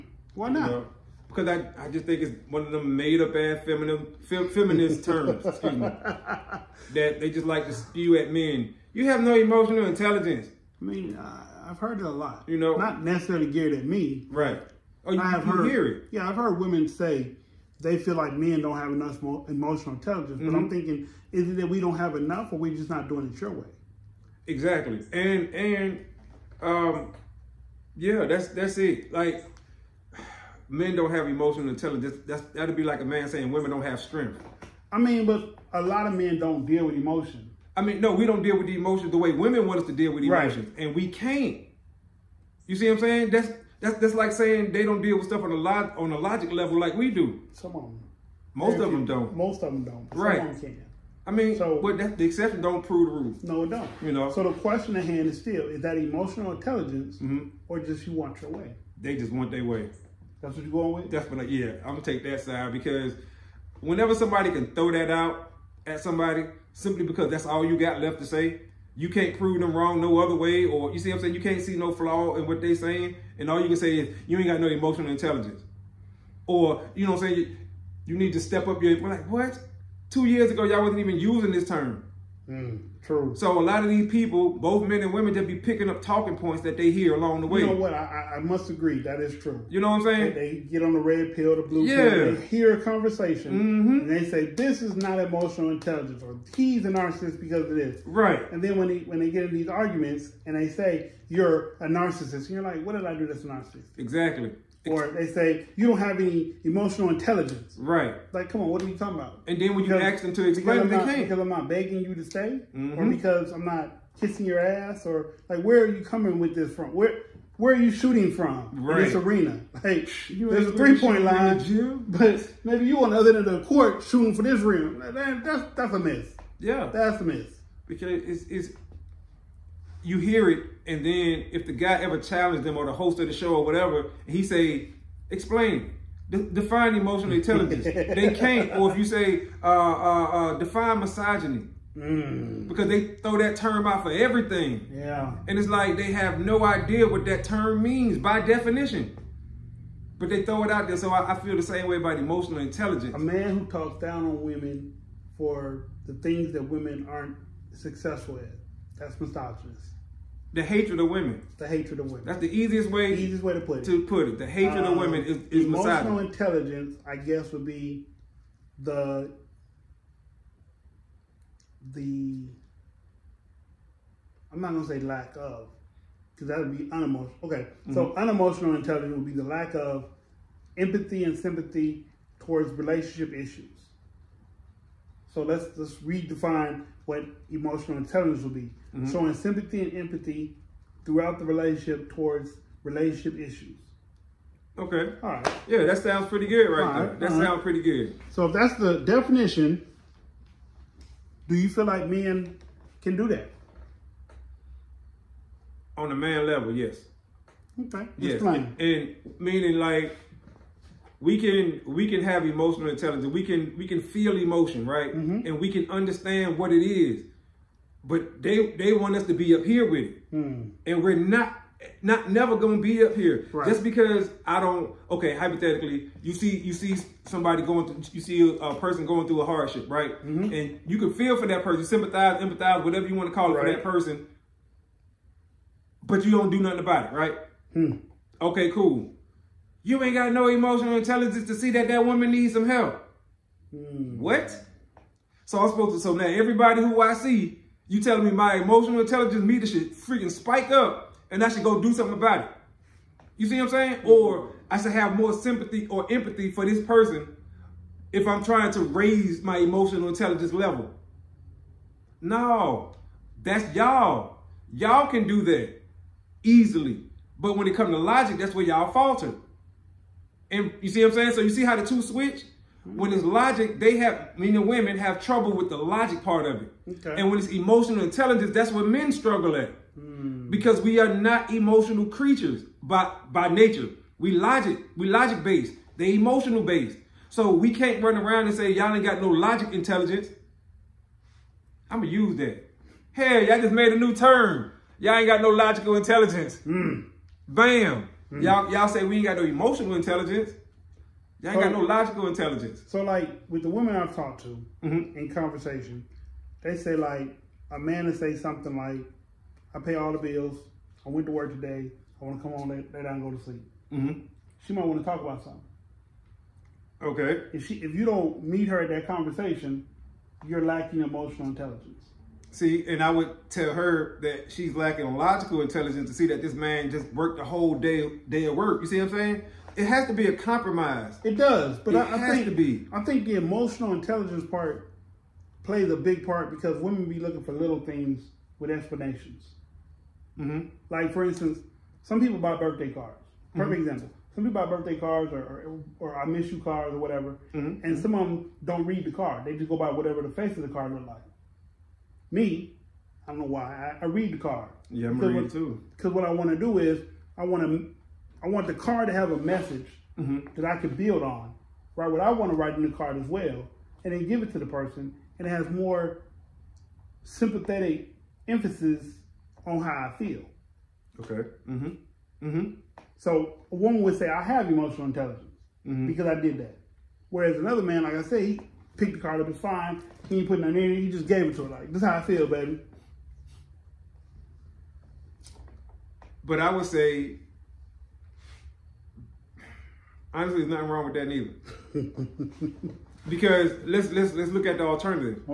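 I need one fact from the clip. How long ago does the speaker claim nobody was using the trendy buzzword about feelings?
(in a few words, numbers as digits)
2 years.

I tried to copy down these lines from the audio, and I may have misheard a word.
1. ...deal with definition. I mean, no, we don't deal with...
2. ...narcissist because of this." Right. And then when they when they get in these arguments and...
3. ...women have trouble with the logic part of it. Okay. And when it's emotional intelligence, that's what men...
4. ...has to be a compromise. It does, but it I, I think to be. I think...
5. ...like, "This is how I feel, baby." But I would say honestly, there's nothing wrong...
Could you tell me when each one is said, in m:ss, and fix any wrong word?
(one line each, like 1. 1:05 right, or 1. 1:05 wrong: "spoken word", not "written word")
1. 0:36 wrong: "emotion", not "definition"
2. 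1:36 right
3. 4:34 right
4. 5:29 right
5. 6:21 right.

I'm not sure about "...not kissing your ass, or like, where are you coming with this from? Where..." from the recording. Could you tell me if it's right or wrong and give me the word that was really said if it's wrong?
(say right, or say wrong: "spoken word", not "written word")
right.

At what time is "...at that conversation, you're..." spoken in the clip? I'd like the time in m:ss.
5:18.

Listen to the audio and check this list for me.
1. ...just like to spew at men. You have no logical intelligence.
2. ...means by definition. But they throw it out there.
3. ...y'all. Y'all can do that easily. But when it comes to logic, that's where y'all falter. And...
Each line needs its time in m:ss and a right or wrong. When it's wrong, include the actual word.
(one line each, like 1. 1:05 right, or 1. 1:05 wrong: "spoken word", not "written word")
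1. 0:07 wrong: "emotional", not "logical"
2. 2:27 right
3. 4:23 right.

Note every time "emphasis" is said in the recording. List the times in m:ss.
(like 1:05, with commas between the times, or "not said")
6:08.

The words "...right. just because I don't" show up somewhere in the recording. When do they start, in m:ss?
3:43.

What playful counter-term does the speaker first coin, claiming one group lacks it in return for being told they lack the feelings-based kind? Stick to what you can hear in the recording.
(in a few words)
logic intelligence.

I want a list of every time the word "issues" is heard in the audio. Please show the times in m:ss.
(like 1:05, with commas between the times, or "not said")
3:03, 3:13.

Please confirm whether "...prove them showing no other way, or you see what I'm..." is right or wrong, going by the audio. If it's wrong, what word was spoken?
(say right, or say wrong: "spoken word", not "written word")
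wrong: "wrong", not "showing".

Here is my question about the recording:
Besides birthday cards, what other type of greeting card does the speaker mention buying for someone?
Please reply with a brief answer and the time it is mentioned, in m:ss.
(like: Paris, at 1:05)
I miss you cards, at 5:46.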